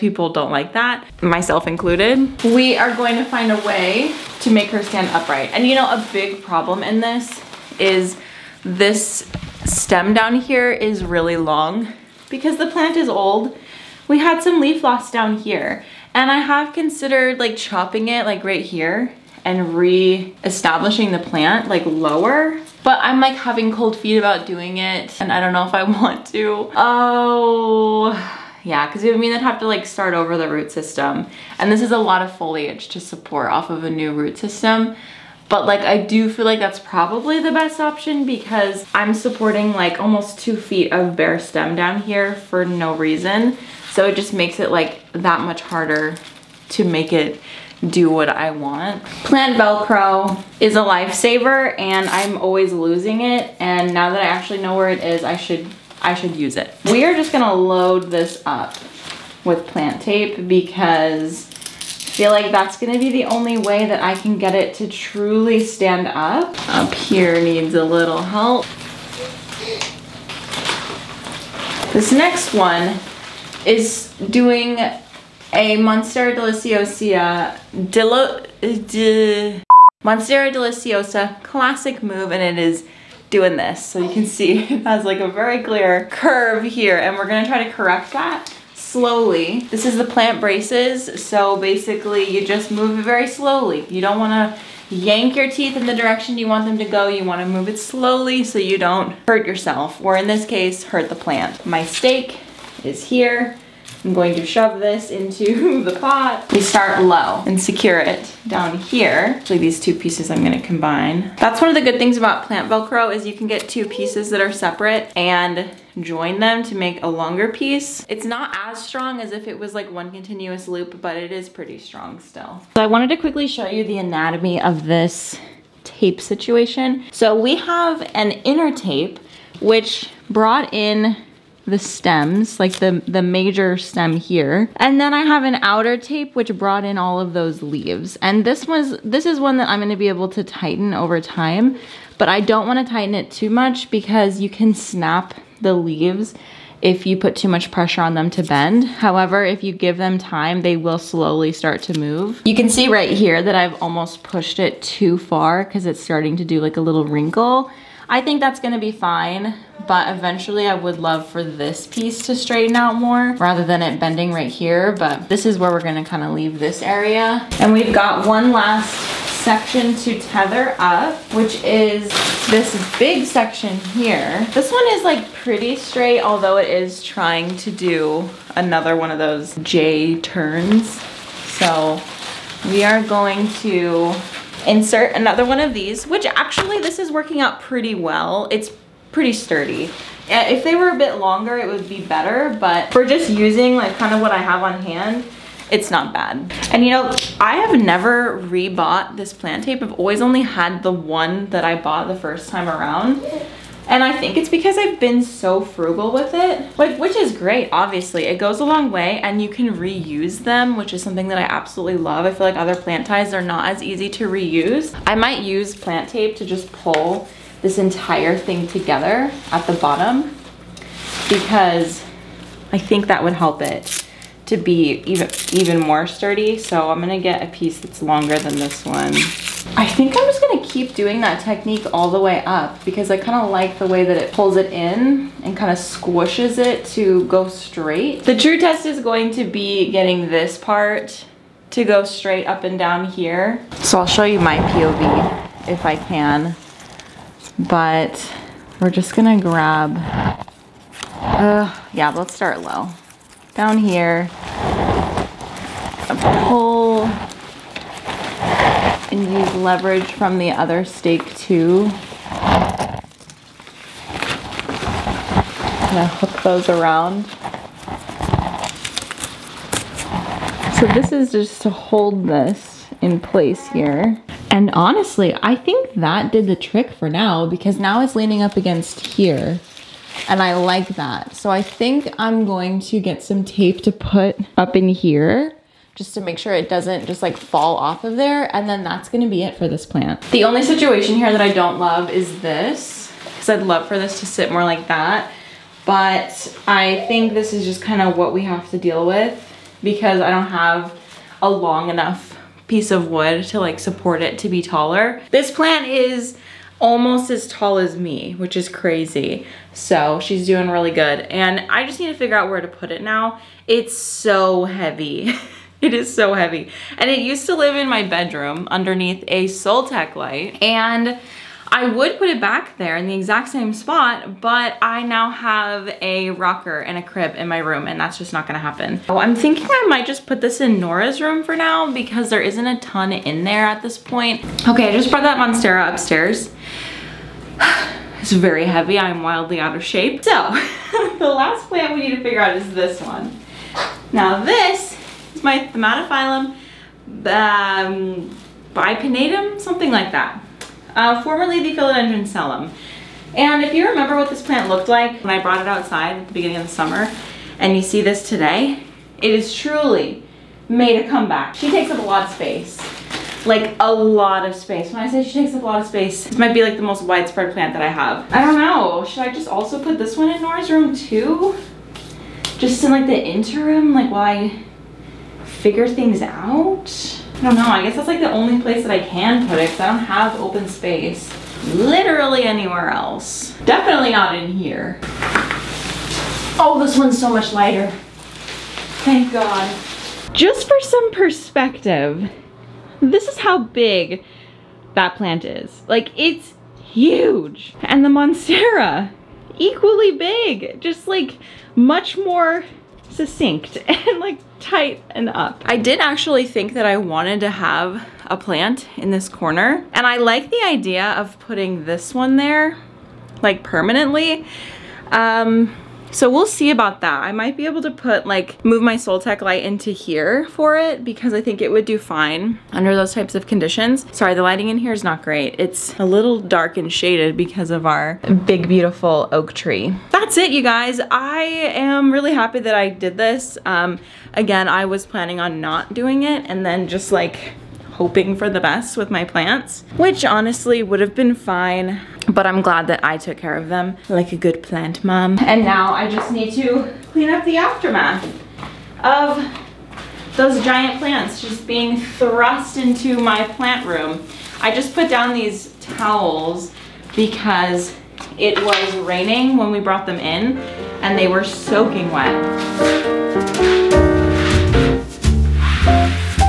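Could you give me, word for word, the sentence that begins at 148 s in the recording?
However, if you give them time, they will slowly start to move.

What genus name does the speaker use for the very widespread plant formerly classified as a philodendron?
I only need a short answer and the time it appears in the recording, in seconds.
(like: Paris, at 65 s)
Thaumatophyllum, at 345 s.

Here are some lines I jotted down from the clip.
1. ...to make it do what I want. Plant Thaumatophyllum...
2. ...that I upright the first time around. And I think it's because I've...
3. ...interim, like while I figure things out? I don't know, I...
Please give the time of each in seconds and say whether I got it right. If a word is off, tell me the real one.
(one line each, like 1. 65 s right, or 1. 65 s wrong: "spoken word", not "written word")
1. 46 s wrong: "Velcro", not "Thaumatophyllum"
2. 201 s wrong: "bought", not "upright"
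3. 373 s right.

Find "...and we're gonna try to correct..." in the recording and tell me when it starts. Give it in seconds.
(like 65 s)
86 s.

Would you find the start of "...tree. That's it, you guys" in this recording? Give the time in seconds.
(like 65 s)
429 s.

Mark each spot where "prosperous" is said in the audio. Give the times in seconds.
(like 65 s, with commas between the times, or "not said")
not said.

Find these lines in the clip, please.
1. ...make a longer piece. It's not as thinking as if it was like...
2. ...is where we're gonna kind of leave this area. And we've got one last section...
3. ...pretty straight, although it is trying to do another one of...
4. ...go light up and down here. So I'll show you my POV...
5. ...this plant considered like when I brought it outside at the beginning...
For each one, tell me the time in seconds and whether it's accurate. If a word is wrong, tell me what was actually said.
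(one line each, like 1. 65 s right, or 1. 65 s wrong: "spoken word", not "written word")
1. 116 s wrong: "strong", not "thinking"
2. 165 s right
3. 175 s right
4. 241 s wrong: "straight", not "light"
5. 354 s wrong: "looked", not "considered".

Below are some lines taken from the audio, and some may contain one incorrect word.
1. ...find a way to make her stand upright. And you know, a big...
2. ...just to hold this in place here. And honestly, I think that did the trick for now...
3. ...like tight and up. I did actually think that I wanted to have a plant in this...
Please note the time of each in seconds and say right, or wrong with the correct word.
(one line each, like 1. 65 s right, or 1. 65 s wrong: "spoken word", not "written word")
1. 3 s right
2. 271 s right
3. 404 s right.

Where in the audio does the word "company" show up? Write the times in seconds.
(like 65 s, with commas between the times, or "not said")
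not said.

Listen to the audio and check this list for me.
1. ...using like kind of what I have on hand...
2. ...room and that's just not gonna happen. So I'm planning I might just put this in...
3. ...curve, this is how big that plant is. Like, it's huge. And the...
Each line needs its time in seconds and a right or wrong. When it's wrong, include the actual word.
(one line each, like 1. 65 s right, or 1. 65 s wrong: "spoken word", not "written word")
1. 193 s right
2. 327 s wrong: "thinking", not "planning"
3. 391 s wrong: "perspective", not "curve".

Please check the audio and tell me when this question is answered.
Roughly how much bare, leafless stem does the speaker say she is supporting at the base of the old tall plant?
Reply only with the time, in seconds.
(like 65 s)
39 s.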